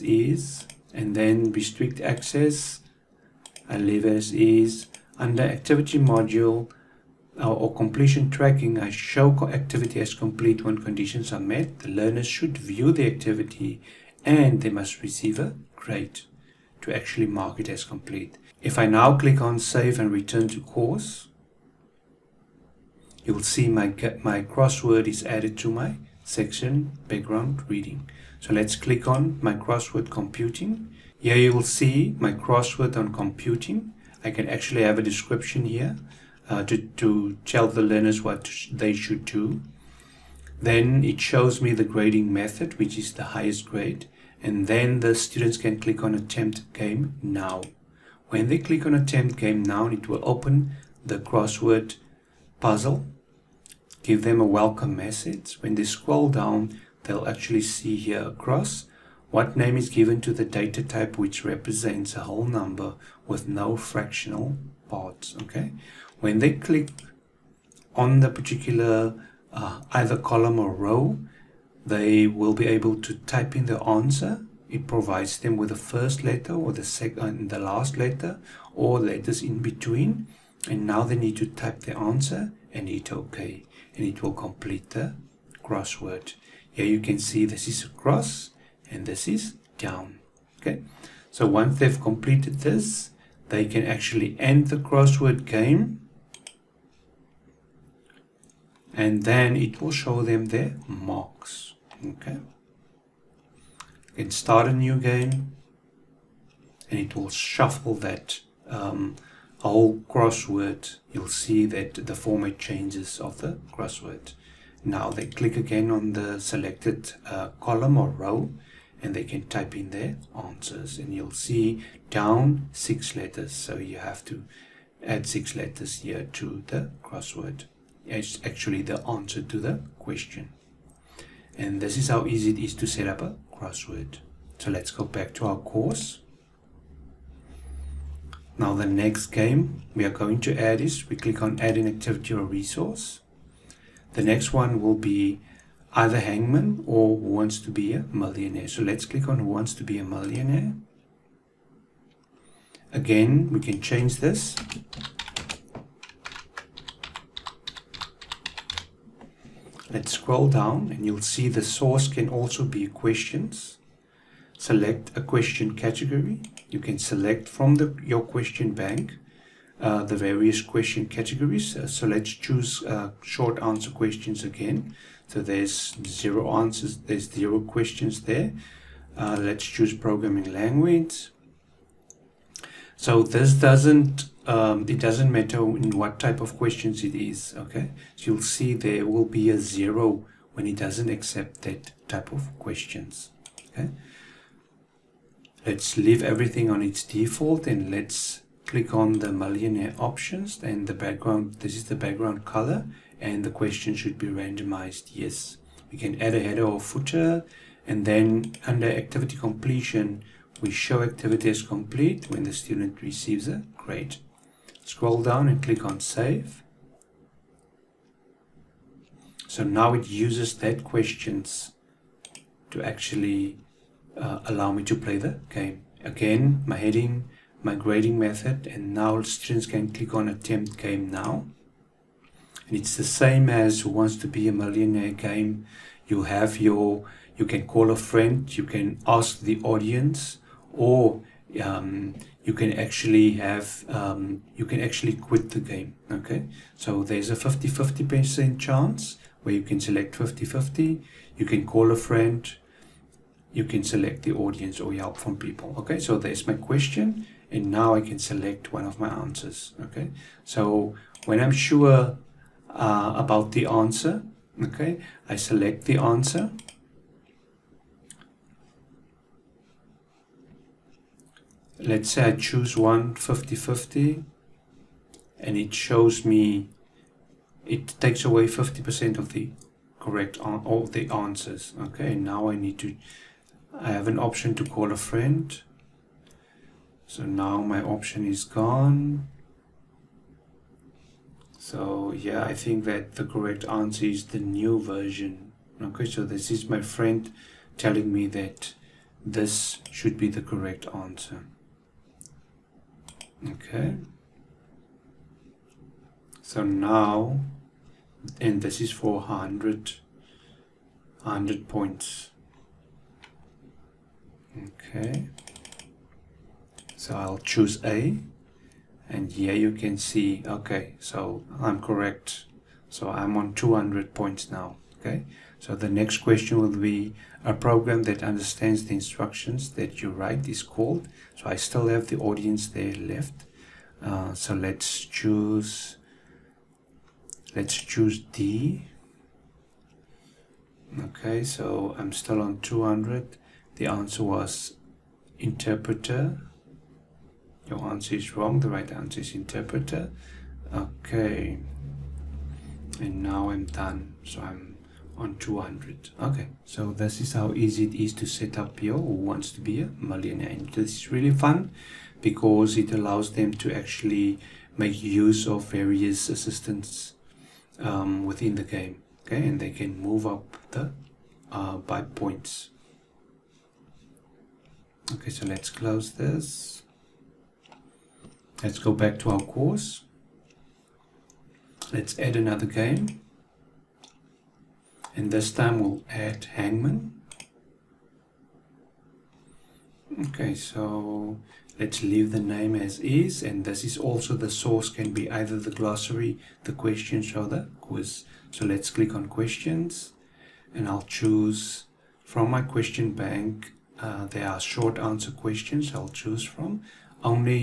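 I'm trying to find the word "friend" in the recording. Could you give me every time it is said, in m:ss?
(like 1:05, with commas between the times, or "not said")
3:57, 4:11, 4:44, 4:56.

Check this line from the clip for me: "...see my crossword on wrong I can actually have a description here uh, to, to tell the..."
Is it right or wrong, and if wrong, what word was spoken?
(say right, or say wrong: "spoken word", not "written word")
wrong: "computing", not "wrong".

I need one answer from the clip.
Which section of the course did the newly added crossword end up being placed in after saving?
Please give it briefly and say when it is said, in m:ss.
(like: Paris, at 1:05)
Background reading, at 0:27.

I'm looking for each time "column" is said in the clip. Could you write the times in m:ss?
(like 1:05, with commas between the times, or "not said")
1:10, 1:57.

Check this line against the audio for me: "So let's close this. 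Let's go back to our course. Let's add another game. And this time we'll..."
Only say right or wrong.
right.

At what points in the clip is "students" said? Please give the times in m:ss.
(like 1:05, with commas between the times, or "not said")
0:45, 3:32, 3:49.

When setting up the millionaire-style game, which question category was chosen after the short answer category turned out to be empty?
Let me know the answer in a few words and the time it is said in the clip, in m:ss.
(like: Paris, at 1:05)
Programming language, at 2:59.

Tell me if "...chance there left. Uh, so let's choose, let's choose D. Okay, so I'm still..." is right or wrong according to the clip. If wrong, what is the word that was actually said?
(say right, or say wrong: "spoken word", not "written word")
wrong: "audience", not "chance".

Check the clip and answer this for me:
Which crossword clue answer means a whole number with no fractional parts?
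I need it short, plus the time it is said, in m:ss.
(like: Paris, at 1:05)
Data type, at 1:00.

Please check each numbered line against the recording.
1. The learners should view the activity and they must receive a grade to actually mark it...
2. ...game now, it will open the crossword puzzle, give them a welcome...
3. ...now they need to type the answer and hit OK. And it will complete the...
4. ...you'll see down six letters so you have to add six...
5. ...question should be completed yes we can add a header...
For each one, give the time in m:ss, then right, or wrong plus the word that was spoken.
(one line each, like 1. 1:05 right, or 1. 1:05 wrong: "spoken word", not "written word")
1. 0:11 right
2. 0:49 right
3. 1:20 right
4. 2:01 right
5. 3:23 wrong: "randomized", not "completed".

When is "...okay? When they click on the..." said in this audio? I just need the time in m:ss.
1:05.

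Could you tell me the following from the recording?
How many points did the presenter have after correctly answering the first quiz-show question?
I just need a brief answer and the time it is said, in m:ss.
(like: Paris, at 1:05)
200, at 5:23.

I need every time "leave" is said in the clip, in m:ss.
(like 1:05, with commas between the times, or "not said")
0:03, 3:15, 6:32.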